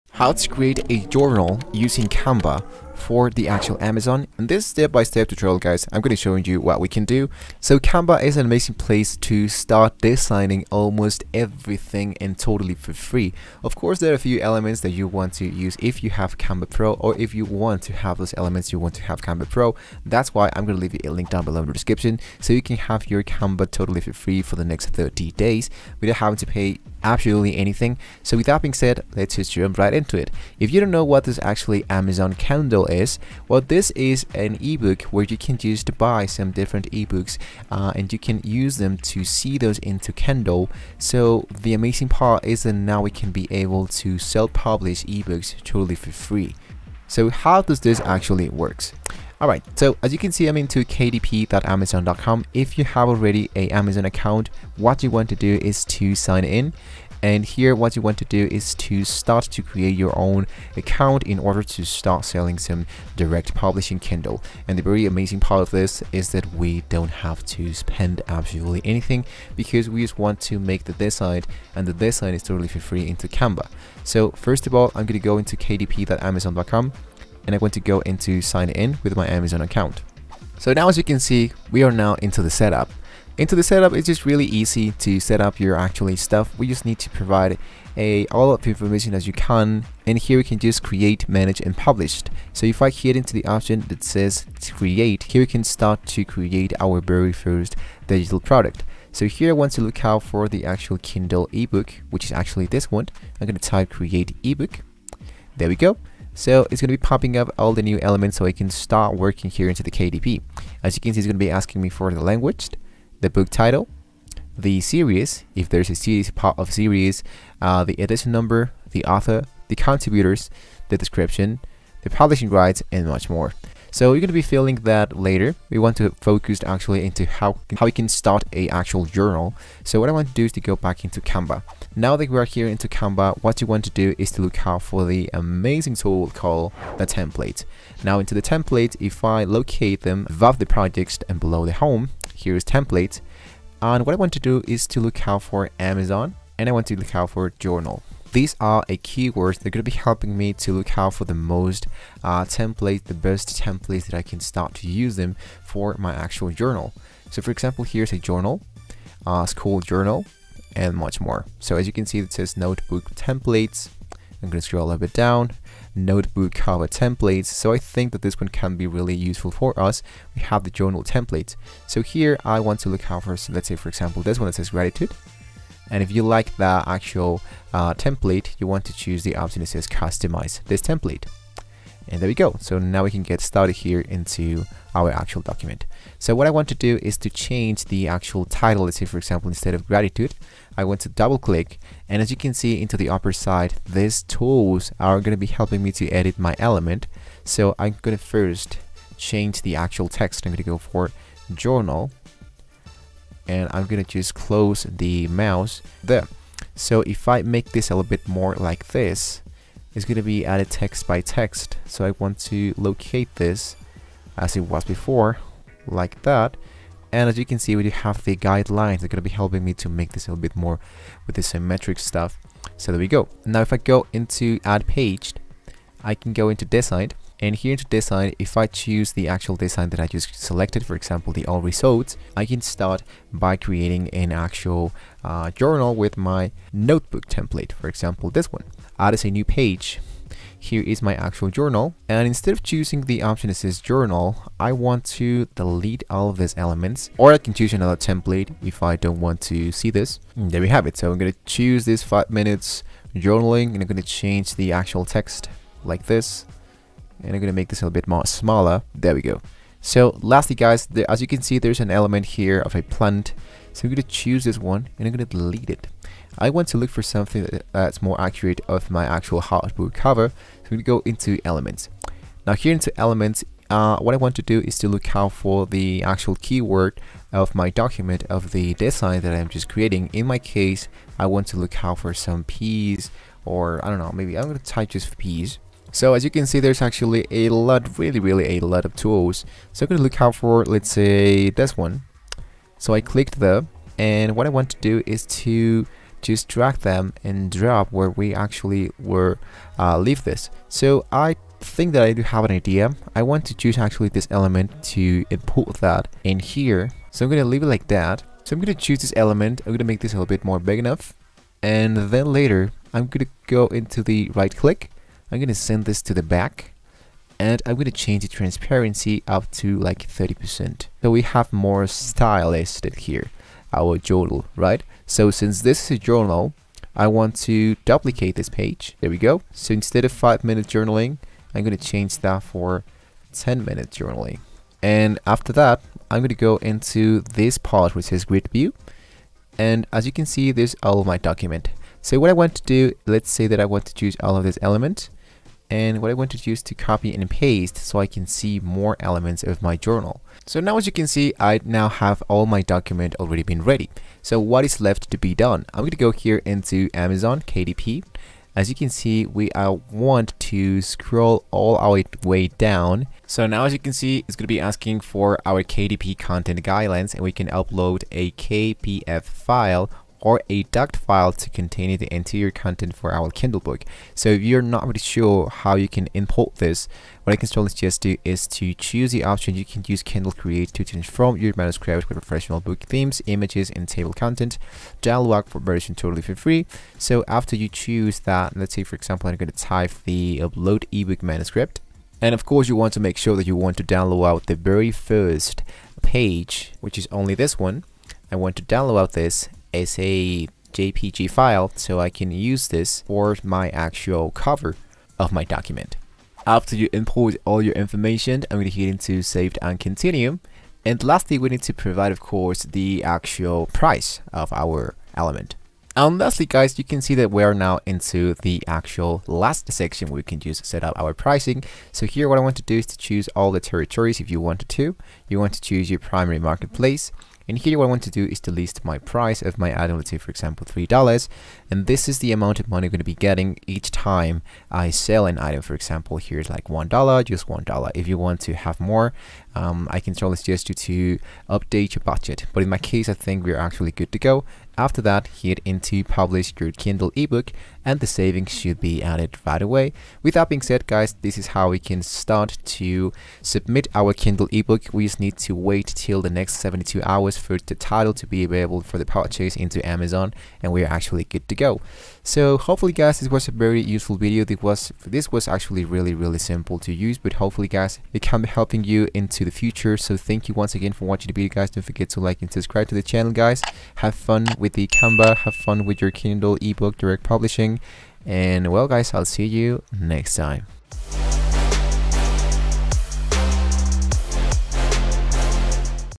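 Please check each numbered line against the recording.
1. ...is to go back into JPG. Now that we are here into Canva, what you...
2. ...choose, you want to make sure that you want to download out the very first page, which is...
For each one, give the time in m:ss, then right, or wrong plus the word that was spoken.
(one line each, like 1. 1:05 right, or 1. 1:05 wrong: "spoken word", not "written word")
1. 2:10 wrong: "Canva", not "JPG"
2. 6:32 wrong: "course", not "choose".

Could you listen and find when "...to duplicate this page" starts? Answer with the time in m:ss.
5:27.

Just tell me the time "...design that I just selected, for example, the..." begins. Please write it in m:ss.
3:49.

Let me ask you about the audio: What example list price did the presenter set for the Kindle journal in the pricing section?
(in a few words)
$3.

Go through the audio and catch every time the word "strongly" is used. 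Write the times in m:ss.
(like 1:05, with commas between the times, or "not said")
6:17, 7:20.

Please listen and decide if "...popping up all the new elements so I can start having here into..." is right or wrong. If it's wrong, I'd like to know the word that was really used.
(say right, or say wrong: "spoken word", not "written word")
wrong: "working", not "having".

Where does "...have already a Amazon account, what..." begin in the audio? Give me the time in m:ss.
0:52.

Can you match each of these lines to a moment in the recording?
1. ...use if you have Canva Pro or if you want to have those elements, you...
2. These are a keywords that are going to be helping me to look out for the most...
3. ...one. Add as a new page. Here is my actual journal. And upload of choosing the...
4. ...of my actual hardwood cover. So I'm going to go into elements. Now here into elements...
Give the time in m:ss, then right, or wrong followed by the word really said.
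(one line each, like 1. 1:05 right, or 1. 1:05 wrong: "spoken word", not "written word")
1. 0:15 right
2. 2:28 right
3. 3:58 wrong: "instead", not "upload"
4. 4:28 right.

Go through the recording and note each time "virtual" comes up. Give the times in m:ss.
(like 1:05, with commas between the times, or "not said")
not said.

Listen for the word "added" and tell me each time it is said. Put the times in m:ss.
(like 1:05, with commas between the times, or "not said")
3:30, 7:29.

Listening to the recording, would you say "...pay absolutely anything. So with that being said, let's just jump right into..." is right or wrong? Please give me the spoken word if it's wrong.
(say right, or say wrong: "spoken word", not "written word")
right.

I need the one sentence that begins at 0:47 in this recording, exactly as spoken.
So how does this actually works?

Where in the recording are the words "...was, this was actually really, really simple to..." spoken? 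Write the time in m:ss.
7:44.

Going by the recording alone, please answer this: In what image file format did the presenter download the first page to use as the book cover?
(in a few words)
JPG.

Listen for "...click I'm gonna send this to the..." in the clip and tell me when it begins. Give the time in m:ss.
5:14.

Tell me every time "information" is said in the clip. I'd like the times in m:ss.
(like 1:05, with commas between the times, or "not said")
1:28, 6:47.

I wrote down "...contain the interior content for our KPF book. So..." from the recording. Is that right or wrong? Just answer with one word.
wrong.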